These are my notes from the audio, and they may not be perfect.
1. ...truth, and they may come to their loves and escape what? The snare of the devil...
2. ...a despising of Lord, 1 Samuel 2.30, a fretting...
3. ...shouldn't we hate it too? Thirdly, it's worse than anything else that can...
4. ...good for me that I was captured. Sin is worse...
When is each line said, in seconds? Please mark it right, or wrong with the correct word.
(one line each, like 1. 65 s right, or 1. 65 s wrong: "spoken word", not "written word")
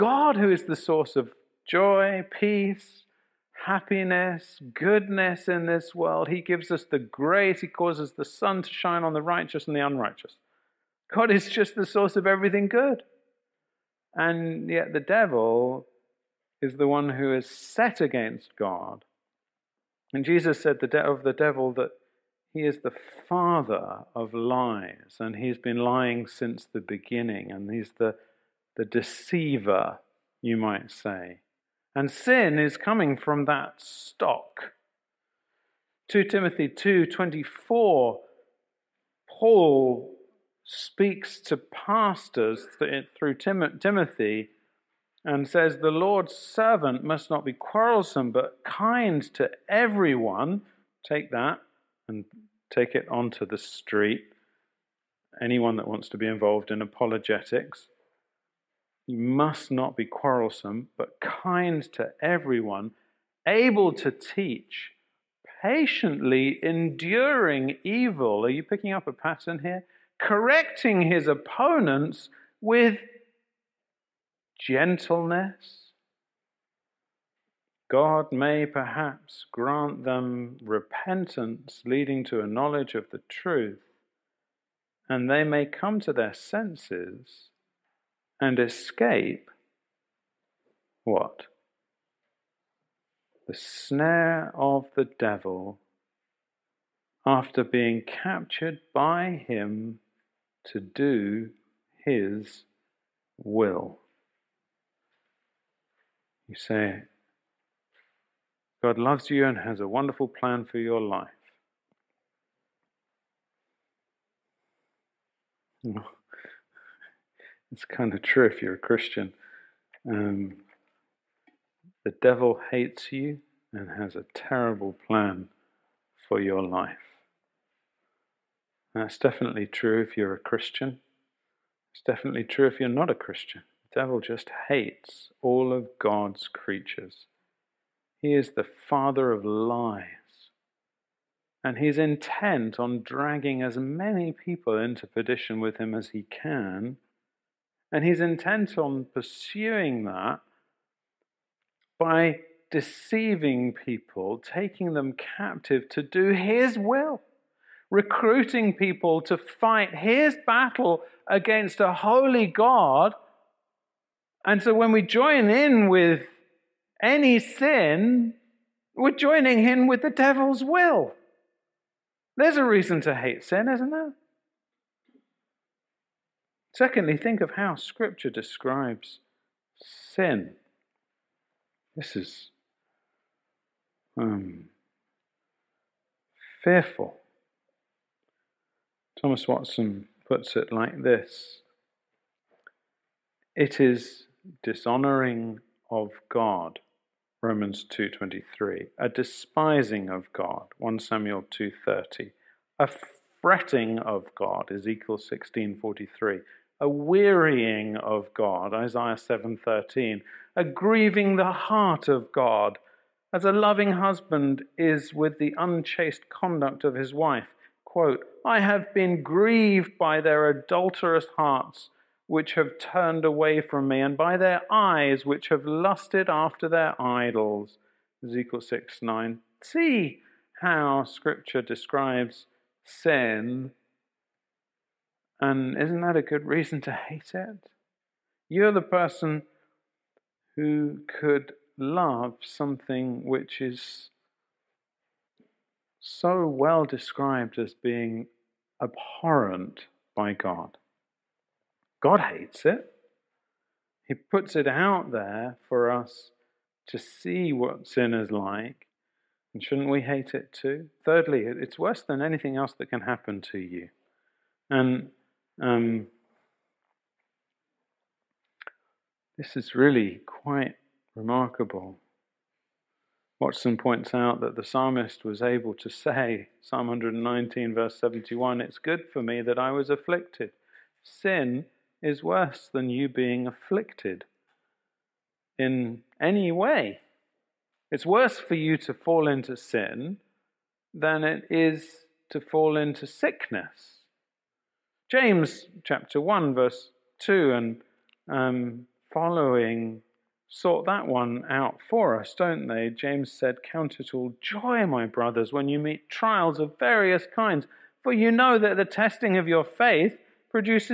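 1. 83 s wrong: "senses", not "loves"
2. 198 s wrong: "God", not "Lord"
3. 259 s right
4. 278 s wrong: "afflicted", not "captured".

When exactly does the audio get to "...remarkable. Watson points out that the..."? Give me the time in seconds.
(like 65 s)
271 s.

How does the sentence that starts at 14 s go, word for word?
And yet the devil is the one who is set against God.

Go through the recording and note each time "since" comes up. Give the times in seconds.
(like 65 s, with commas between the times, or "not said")
26 s.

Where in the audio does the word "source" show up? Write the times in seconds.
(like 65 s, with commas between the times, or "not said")
0 s, 11 s.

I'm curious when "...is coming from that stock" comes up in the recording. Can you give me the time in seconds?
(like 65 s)
32 s.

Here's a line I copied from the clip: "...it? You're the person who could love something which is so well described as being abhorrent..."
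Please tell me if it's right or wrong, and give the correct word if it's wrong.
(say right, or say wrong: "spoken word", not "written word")
right.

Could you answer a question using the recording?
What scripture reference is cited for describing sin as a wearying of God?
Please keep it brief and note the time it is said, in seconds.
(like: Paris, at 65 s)
Isaiah 7:13, at 208 s.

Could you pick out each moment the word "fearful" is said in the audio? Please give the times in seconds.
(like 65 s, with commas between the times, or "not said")
186 s.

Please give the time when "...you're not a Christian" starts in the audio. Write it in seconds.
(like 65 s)
132 s.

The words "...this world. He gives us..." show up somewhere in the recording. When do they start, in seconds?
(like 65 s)
5 s.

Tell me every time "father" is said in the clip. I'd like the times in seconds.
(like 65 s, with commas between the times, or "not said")
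23 s, 138 s.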